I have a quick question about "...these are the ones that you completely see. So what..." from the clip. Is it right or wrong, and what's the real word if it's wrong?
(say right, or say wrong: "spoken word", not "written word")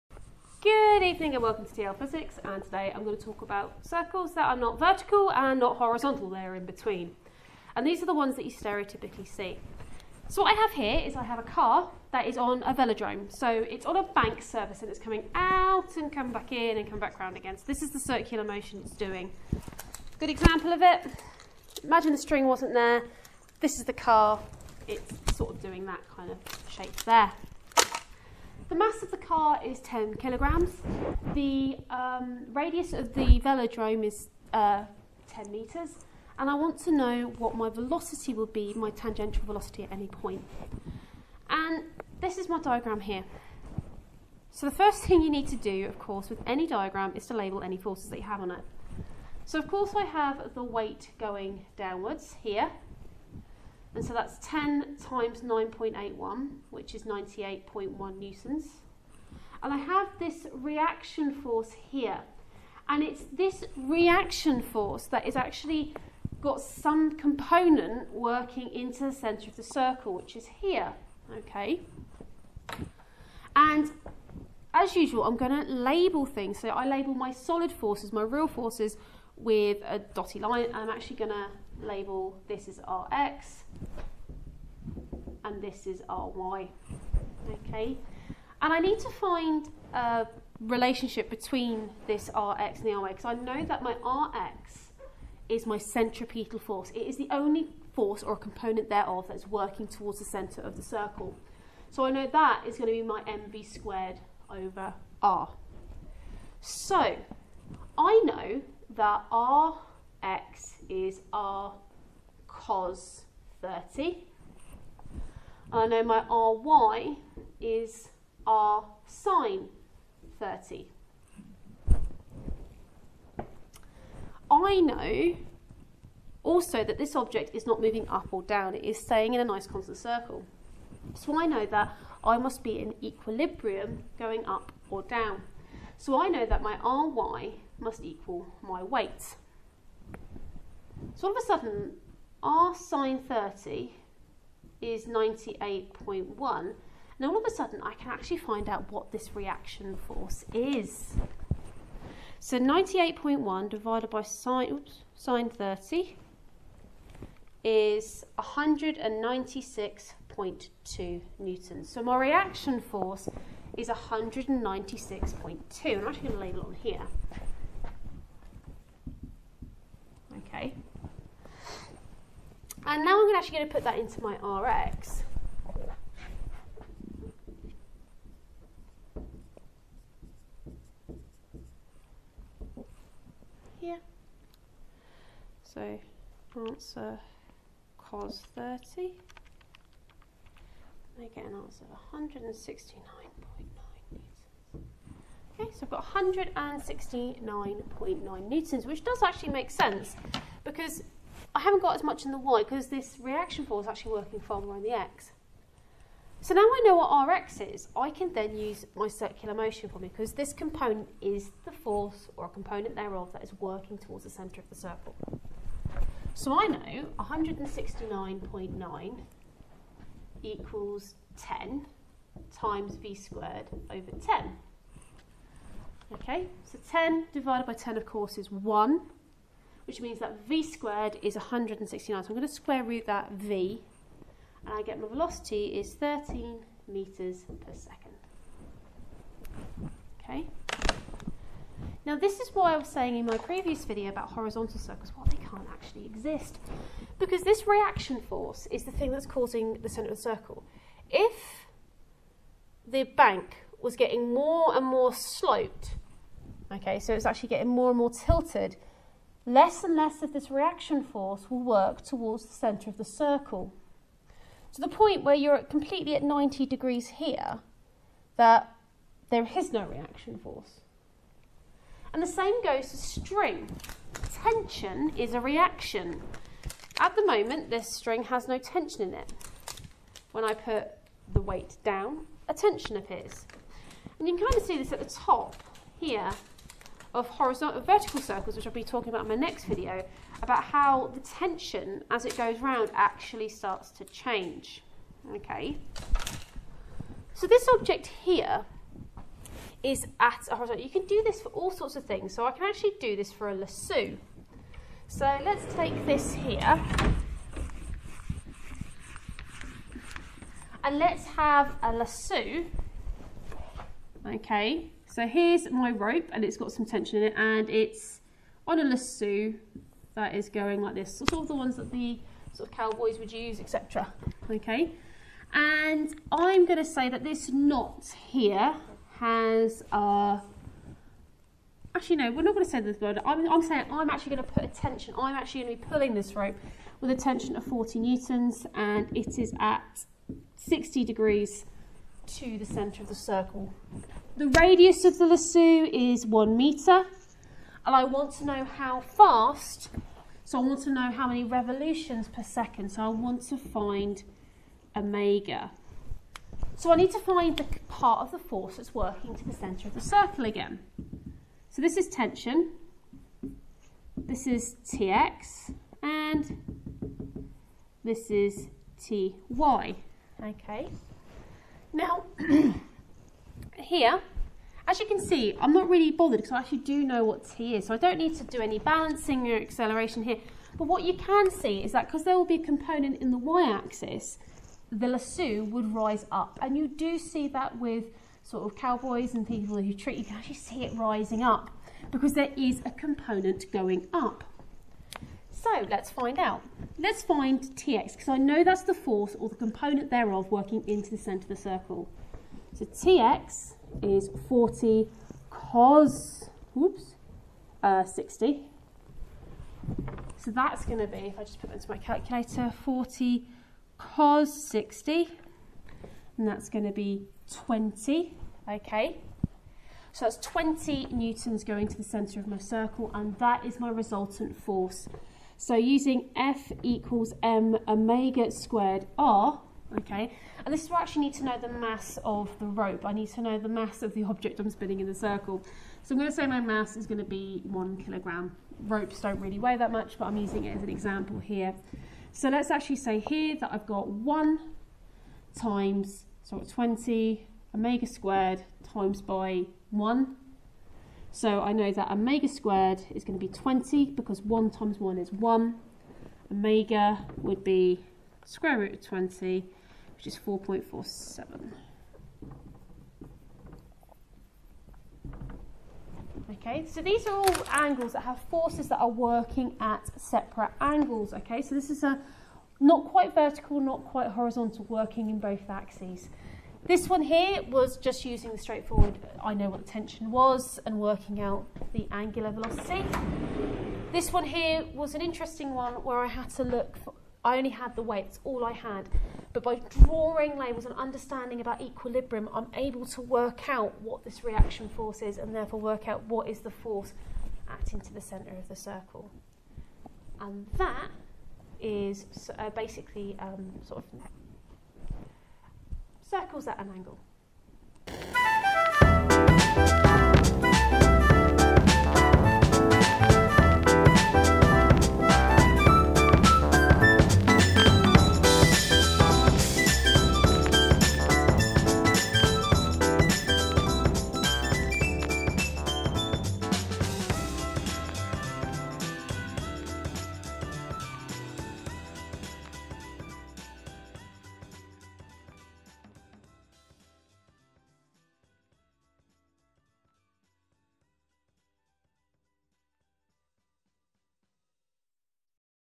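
wrong: "stereotypically", not "completely".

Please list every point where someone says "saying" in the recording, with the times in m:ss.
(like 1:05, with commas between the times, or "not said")
4:02, 5:33.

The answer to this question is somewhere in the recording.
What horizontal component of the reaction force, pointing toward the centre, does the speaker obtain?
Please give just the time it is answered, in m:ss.
3:16.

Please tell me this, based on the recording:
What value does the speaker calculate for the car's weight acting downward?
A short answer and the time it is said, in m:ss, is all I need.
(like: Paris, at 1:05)
98.1 newtons, at 0:57.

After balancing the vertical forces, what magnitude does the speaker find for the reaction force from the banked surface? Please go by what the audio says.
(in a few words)
196.2 newtons.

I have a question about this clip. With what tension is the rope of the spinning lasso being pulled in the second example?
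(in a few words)
40 newtons.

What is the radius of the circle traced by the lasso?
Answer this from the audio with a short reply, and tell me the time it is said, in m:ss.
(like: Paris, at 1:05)
1 metre, at 5:46.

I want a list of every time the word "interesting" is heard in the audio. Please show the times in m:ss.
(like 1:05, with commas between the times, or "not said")
8:05.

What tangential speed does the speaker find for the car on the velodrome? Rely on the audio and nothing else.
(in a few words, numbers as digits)
13 metres per second.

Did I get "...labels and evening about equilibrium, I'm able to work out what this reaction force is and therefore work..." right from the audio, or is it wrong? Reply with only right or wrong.
wrong.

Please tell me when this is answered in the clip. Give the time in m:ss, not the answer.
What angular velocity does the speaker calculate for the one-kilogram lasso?
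7:40.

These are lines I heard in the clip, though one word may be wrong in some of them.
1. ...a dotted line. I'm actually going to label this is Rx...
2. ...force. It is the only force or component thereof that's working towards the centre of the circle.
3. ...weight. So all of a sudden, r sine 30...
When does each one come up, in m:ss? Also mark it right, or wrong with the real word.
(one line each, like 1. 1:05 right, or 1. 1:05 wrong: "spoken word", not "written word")
1. 1:19 right
2. 1:36 right
3. 2:18 right.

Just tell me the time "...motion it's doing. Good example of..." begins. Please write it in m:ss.
0:18.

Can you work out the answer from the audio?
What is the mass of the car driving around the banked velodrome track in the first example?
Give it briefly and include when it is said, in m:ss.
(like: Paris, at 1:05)
10 kilograms, at 0:29.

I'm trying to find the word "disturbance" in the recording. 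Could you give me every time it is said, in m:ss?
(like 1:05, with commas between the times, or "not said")
not said.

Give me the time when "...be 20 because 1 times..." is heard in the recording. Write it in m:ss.
7:33.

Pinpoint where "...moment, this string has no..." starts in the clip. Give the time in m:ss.
4:37.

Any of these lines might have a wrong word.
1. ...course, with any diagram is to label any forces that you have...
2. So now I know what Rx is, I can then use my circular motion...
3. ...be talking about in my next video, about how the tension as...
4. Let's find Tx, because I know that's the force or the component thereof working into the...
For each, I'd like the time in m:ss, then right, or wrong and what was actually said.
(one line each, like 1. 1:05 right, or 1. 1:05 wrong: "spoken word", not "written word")
1. 0:45 right
2. 3:26 right
3. 4:48 right
4. 6:36 right.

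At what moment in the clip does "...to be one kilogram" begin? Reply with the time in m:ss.
7:17.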